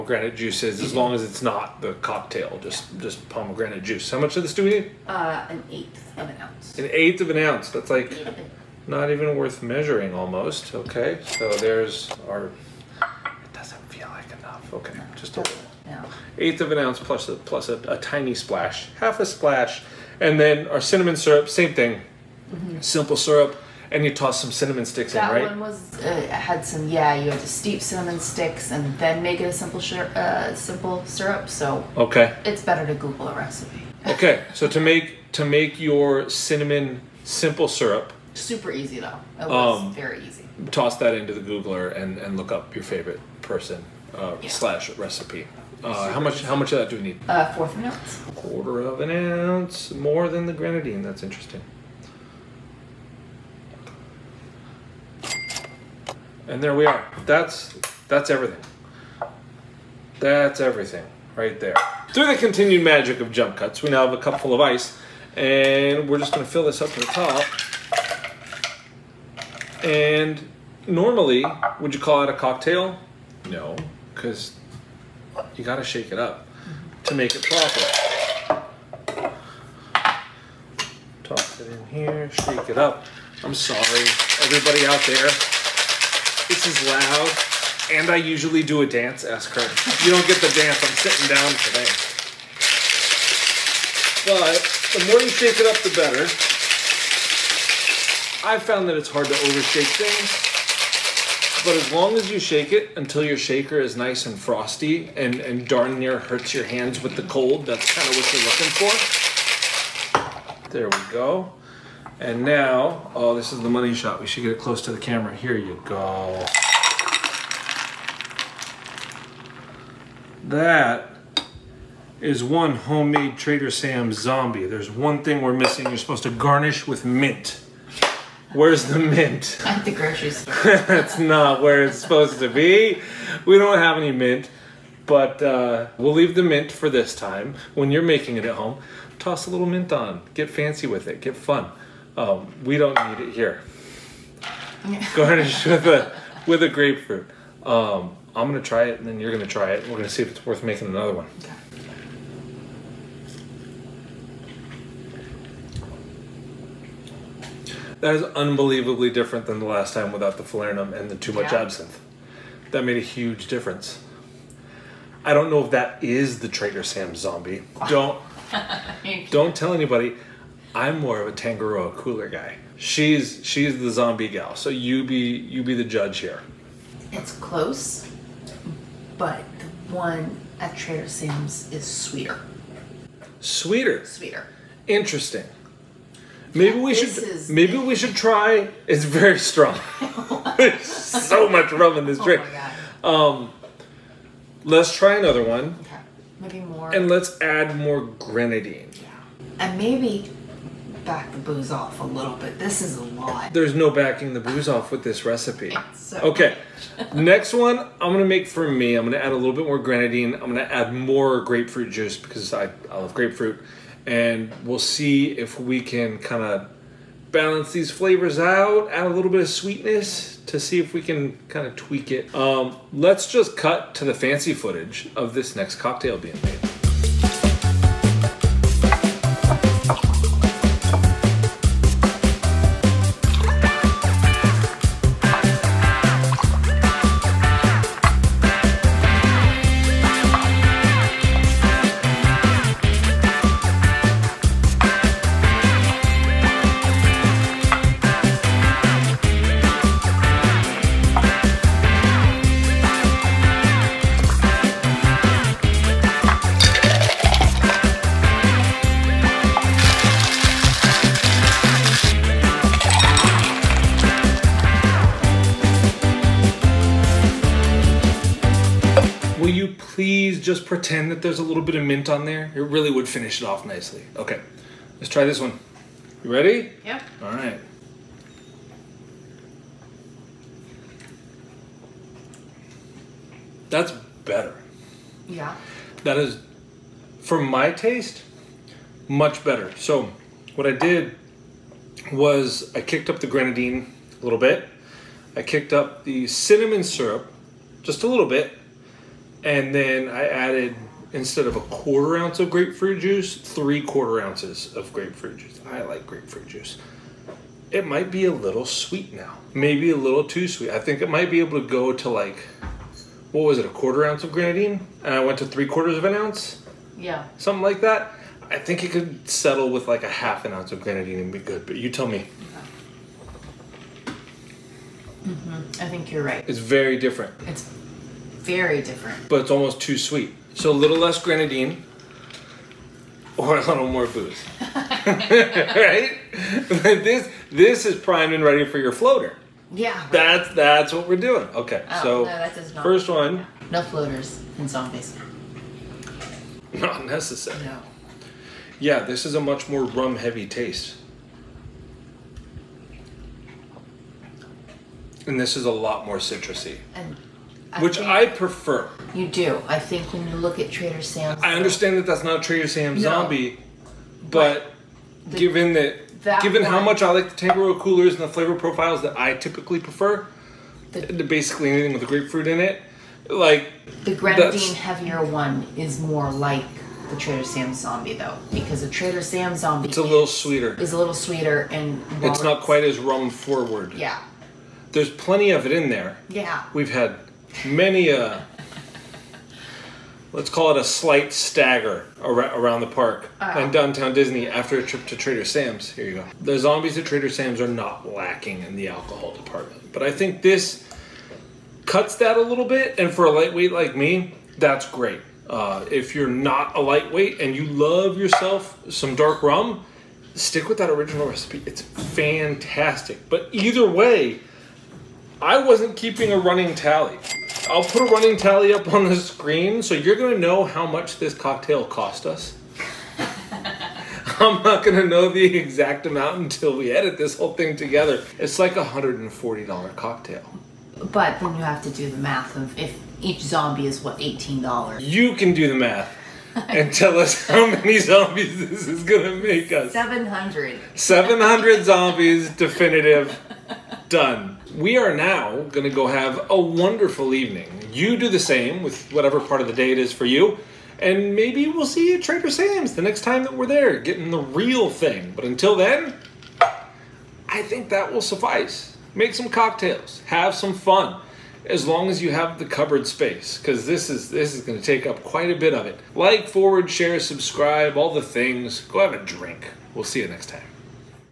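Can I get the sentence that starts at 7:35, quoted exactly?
But until then, I think that will suffice.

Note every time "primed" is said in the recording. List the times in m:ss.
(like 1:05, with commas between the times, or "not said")
5:37.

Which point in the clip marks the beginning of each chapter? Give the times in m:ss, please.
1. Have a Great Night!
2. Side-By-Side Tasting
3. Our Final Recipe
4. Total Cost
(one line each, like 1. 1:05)
1. 7:23
2. 5:29
3. 3:45
4. 6:54.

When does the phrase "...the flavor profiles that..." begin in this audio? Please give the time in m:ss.
6:08.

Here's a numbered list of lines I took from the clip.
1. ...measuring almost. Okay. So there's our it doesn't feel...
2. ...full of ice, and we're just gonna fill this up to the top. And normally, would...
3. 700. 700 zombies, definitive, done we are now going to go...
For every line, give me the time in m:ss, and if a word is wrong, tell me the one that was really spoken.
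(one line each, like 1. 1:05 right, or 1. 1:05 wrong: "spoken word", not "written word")
1. 0:09 right
2. 1:04 right
3. 7:19 right.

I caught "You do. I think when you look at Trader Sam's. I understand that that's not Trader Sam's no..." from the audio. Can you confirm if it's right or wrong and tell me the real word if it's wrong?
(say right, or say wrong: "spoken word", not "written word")
right.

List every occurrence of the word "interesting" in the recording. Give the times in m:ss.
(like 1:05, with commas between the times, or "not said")
0:51, 3:04.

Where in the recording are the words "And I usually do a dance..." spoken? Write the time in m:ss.
1:27.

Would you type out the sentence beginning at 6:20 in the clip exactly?
Is a little sweeter and it's not quite as rum forward.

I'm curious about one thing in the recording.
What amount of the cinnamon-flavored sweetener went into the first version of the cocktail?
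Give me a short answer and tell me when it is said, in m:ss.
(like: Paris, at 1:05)
1/4 ounce, at 0:47.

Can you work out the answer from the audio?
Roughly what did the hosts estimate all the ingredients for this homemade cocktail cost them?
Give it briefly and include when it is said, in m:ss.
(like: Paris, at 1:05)
$140, at 7:08.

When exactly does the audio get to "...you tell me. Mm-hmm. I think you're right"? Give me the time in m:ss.
5:21.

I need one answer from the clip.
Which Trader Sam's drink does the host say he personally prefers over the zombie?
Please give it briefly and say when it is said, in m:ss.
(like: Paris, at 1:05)
Tangaroa cooler, at 2:51.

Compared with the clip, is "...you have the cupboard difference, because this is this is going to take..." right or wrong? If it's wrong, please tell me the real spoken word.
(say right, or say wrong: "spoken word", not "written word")
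wrong: "space", not "difference".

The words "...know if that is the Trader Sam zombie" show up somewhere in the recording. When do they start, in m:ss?
2:45.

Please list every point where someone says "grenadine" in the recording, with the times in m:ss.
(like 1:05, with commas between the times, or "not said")
0:50, 3:18, 3:29, 4:53, 5:14, 5:20, 5:31, 6:14.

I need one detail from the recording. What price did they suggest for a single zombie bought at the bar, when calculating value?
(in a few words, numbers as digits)
$18.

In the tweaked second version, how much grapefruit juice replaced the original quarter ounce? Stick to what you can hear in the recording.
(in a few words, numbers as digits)
3/4 ounce.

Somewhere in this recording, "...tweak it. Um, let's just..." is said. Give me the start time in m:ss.
3:41.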